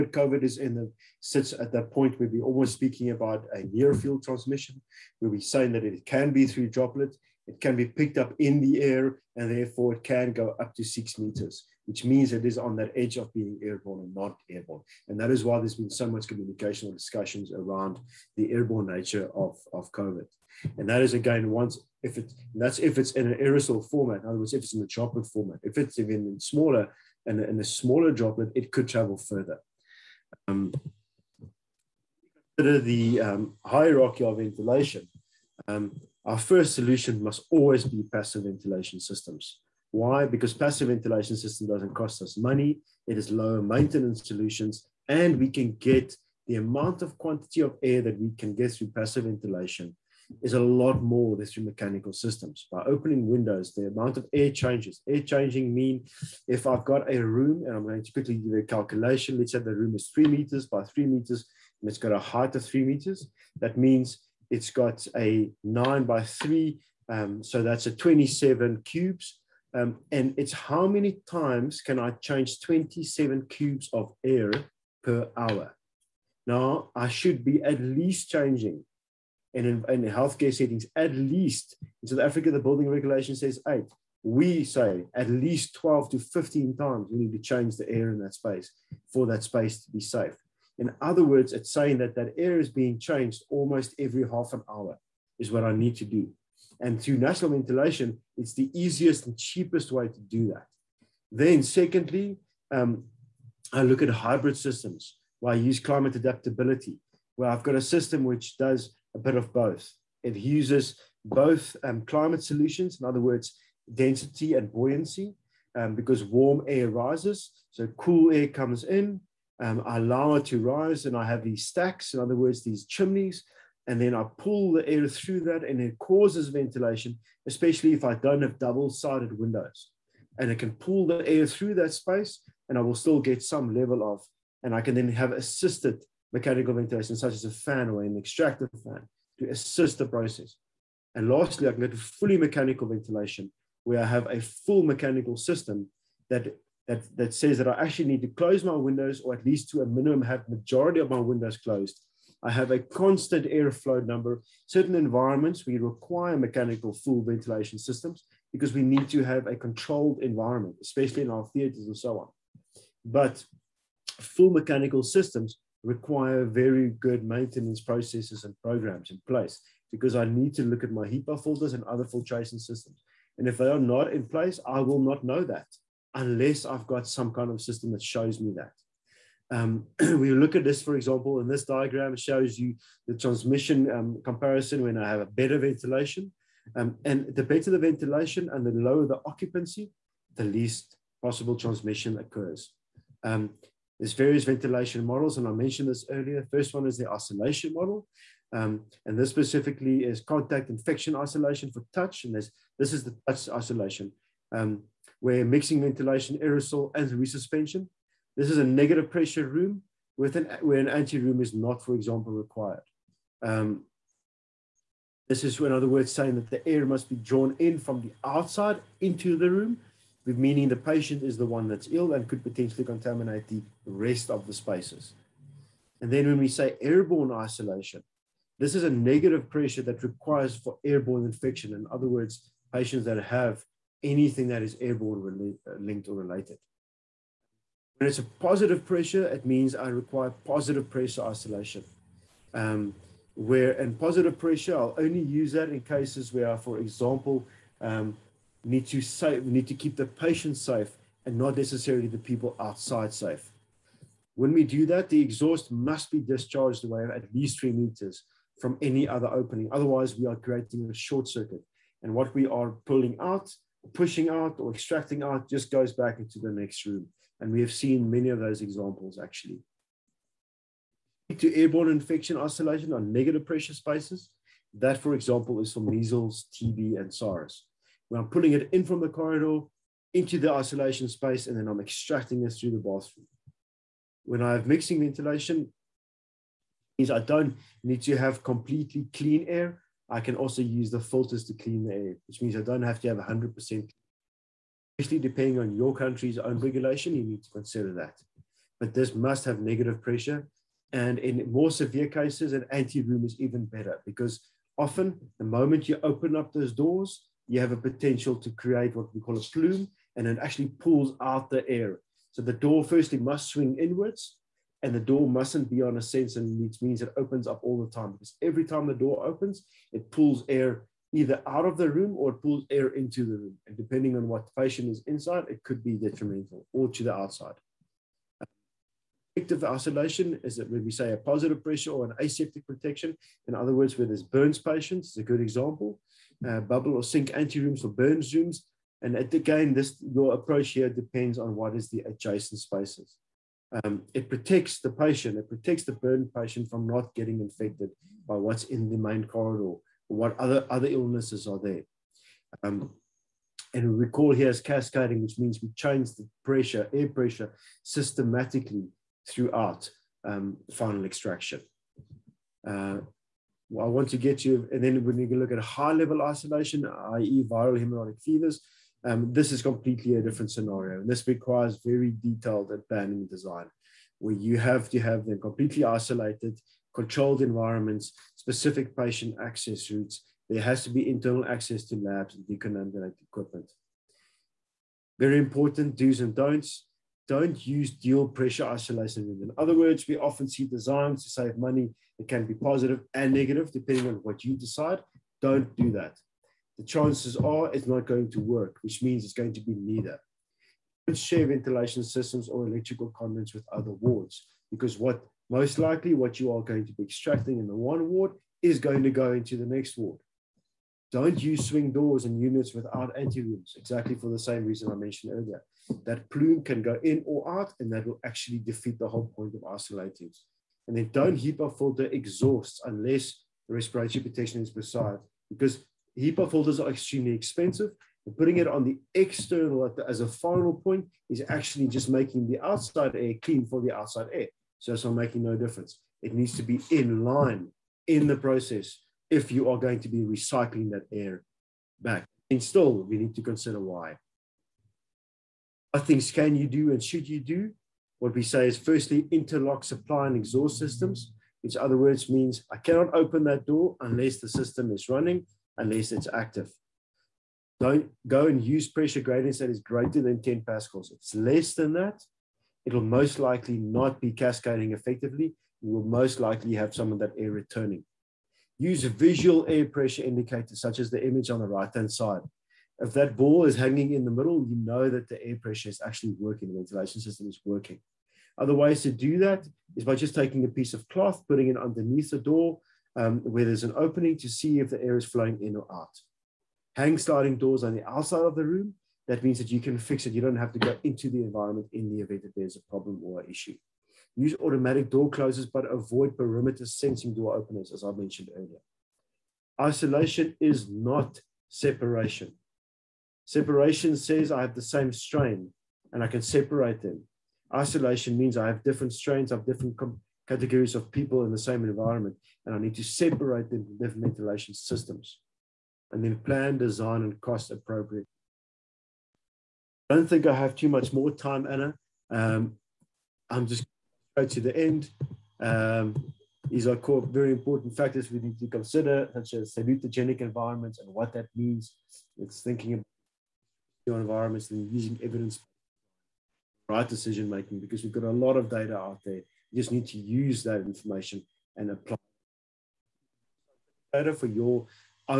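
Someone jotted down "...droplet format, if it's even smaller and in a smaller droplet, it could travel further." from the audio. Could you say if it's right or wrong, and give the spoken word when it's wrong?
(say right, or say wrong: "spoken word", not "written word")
right.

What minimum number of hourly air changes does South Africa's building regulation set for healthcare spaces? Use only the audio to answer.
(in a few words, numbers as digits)
8.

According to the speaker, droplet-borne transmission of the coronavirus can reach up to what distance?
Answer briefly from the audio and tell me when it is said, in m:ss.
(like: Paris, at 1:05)
6 meters, at 0:10.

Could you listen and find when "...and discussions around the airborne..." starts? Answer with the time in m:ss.
0:16.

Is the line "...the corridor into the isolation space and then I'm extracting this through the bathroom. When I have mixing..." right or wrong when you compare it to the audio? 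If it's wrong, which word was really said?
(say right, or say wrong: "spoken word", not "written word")
right.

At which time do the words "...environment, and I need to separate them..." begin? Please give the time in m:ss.
8:31.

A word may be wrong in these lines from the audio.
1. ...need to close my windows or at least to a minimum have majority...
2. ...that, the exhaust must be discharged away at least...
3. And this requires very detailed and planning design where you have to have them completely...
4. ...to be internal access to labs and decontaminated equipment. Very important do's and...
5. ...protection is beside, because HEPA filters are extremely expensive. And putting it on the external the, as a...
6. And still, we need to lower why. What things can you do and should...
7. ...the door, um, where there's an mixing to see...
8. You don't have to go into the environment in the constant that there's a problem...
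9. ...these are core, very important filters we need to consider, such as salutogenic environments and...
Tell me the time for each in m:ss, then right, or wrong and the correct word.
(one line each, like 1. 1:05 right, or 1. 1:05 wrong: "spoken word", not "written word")
1. 2:28 right
2. 4:14 right
3. 6:11 right
4. 6:20 right
5. 7:04 right
6. 7:22 wrong: "consider", not "lower"
7. 8:02 wrong: "opening", not "mixing"
8. 8:10 wrong: "event", not "constant"
9. 8:46 wrong: "factors", not "filters".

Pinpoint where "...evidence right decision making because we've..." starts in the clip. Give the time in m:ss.
8:55.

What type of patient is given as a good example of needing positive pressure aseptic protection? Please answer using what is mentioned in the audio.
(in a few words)
Burns patients.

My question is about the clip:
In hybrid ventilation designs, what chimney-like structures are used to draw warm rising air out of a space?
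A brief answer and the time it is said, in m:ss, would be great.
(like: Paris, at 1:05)
Stacks, at 2:01.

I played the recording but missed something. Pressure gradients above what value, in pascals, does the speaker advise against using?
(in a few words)
10 pascals.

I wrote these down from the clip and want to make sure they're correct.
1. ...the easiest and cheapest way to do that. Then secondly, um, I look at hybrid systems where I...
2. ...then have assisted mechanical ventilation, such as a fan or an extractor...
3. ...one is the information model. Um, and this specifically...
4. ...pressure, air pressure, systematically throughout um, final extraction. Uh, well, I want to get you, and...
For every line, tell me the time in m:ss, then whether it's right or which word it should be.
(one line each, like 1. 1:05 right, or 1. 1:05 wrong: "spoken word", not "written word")
1. 1:38 right
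2. 2:14 right
3. 3:16 wrong: "isolation", not "information"
4. 5:56 right.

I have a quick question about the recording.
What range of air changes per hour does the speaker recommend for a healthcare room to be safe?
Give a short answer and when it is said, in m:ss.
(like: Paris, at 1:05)
12 to 15, at 1:25.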